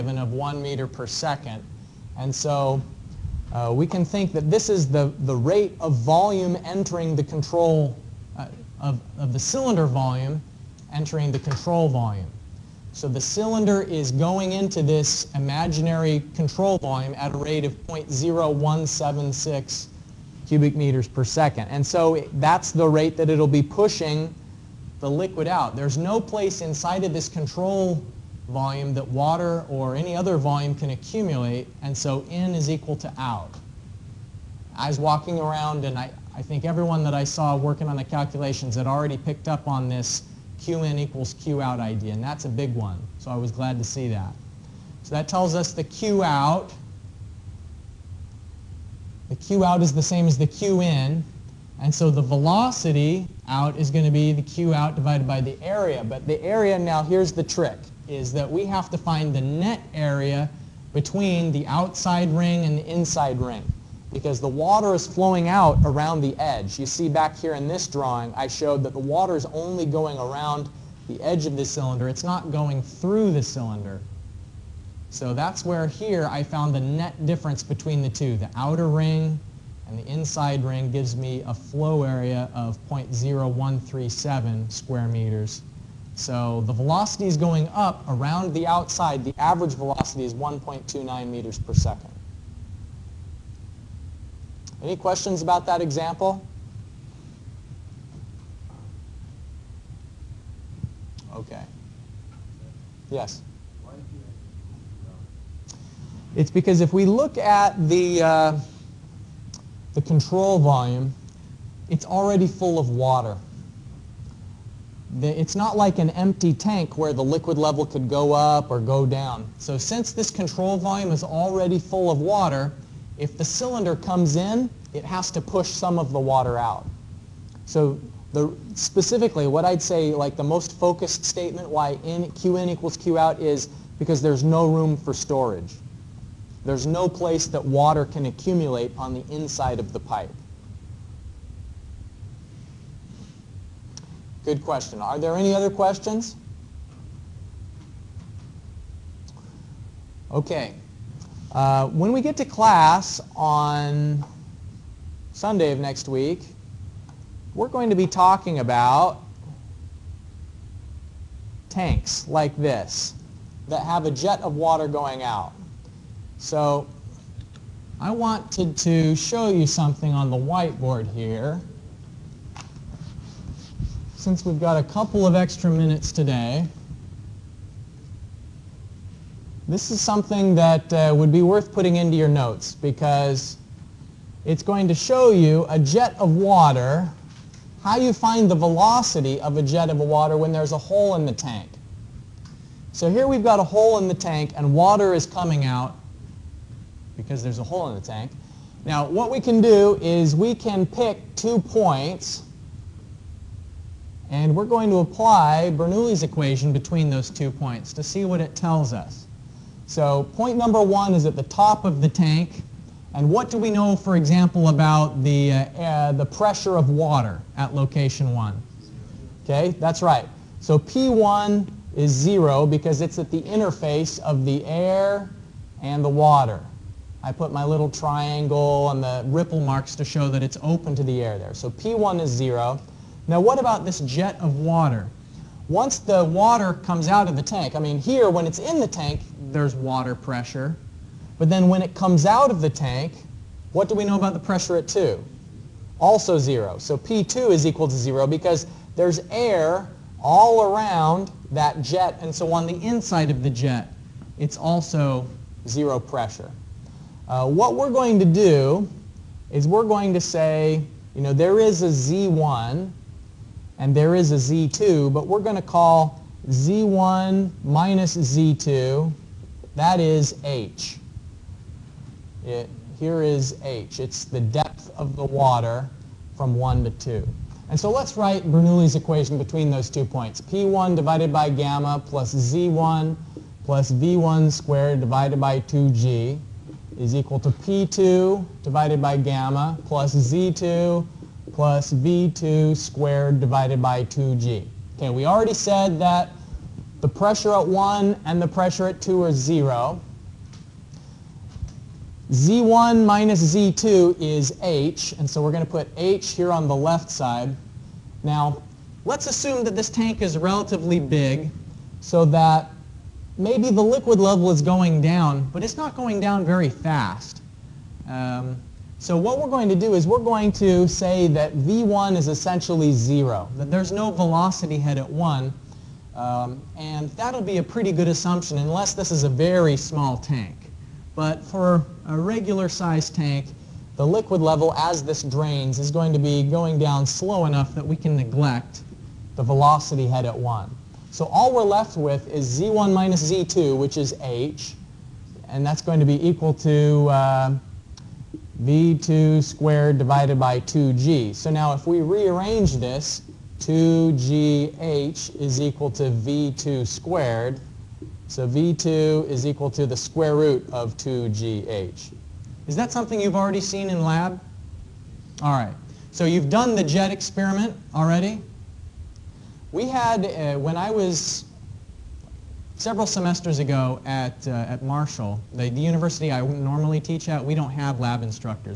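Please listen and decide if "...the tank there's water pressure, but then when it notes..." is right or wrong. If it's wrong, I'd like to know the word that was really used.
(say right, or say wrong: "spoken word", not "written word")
wrong: "comes", not "notes".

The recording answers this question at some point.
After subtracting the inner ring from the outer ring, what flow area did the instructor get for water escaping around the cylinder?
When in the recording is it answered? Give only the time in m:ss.
1:22.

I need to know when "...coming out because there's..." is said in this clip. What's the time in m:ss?
3:15.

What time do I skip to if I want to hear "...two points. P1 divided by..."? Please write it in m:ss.
4:39.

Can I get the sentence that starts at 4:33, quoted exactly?
It's the depth of the water from 1 to 2.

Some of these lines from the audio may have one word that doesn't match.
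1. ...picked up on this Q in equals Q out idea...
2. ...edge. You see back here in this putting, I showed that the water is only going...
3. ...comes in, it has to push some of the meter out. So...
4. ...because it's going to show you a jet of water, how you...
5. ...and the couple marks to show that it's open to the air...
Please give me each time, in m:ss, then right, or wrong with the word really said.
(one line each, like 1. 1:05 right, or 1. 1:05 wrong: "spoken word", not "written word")
1. 0:39 right
2. 1:06 wrong: "drawing", not "putting"
3. 2:03 wrong: "water", not "meter"
4. 3:02 right
5. 3:48 wrong: "ripple", not "couple".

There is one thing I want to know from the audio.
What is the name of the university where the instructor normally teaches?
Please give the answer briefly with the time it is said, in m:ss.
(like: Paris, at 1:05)
Marshall, at 6:14.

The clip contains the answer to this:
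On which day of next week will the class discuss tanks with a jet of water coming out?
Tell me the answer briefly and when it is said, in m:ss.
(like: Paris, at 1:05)
Sunday, at 2:35.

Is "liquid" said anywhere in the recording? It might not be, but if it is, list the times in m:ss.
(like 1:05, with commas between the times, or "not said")
0:25, 1:57, 5:13, 5:34.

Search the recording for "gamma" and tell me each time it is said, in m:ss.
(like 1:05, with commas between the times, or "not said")
4:41, 4:49.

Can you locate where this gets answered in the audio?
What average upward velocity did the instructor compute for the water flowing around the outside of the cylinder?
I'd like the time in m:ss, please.
1:30.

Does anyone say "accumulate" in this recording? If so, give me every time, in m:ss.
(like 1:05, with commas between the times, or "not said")
0:30, 2:18.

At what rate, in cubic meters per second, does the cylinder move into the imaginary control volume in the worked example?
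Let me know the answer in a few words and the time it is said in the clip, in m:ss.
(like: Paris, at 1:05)
0.0176, at 0:17.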